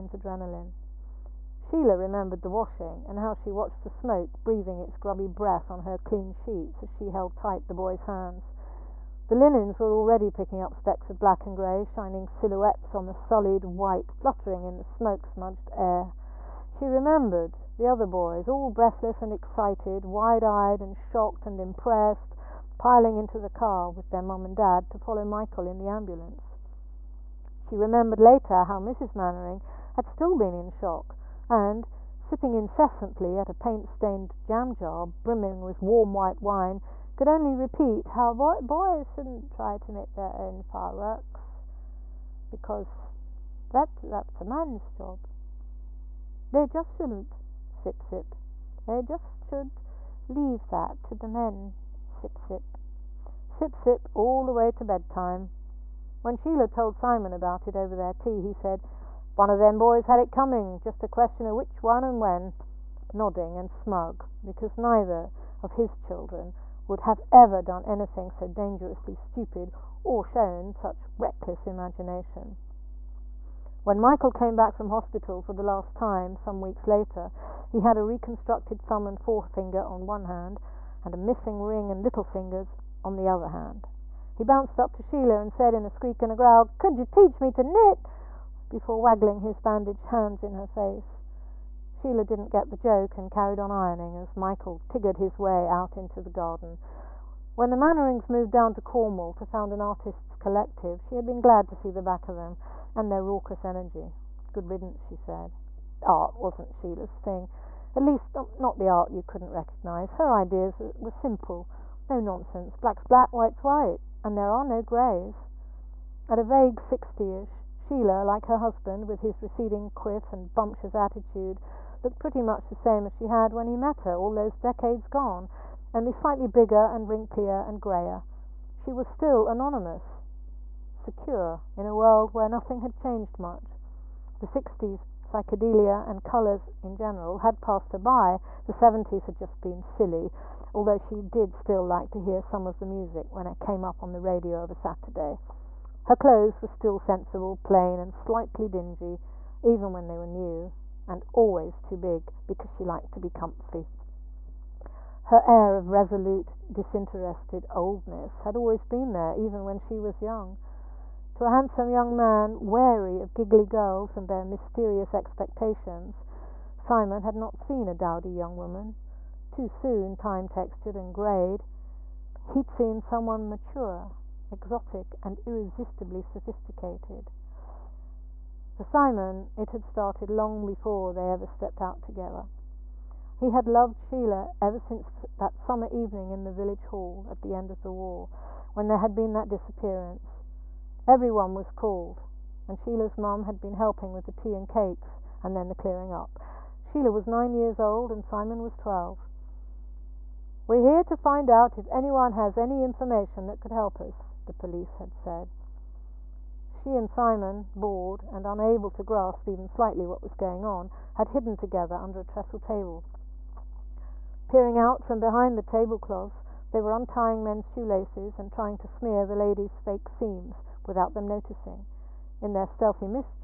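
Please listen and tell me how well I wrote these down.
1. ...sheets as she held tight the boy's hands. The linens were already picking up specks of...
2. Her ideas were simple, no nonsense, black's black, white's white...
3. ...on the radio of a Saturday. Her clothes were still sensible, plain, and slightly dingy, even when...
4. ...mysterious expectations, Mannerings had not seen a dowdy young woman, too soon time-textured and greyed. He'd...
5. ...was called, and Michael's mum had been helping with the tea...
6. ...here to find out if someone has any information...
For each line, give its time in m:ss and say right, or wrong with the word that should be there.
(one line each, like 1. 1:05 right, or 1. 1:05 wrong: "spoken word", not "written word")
1. 0:06 right
2. 1:50 right
3. 2:24 right
4. 2:44 wrong: "Simon", not "Mannerings"
5. 3:11 wrong: "Sheila", not "Michael"
6. 3:20 wrong: "anyone", not "someone".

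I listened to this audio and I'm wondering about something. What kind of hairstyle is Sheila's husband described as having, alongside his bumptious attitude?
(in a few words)
receding quiff.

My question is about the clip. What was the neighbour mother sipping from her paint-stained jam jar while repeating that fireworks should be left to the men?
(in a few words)
warm white wine.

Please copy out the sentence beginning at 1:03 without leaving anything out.
Nodding and smug, because neither of his children would have ever done anything so dangerously stupid or shown such reckless imagination.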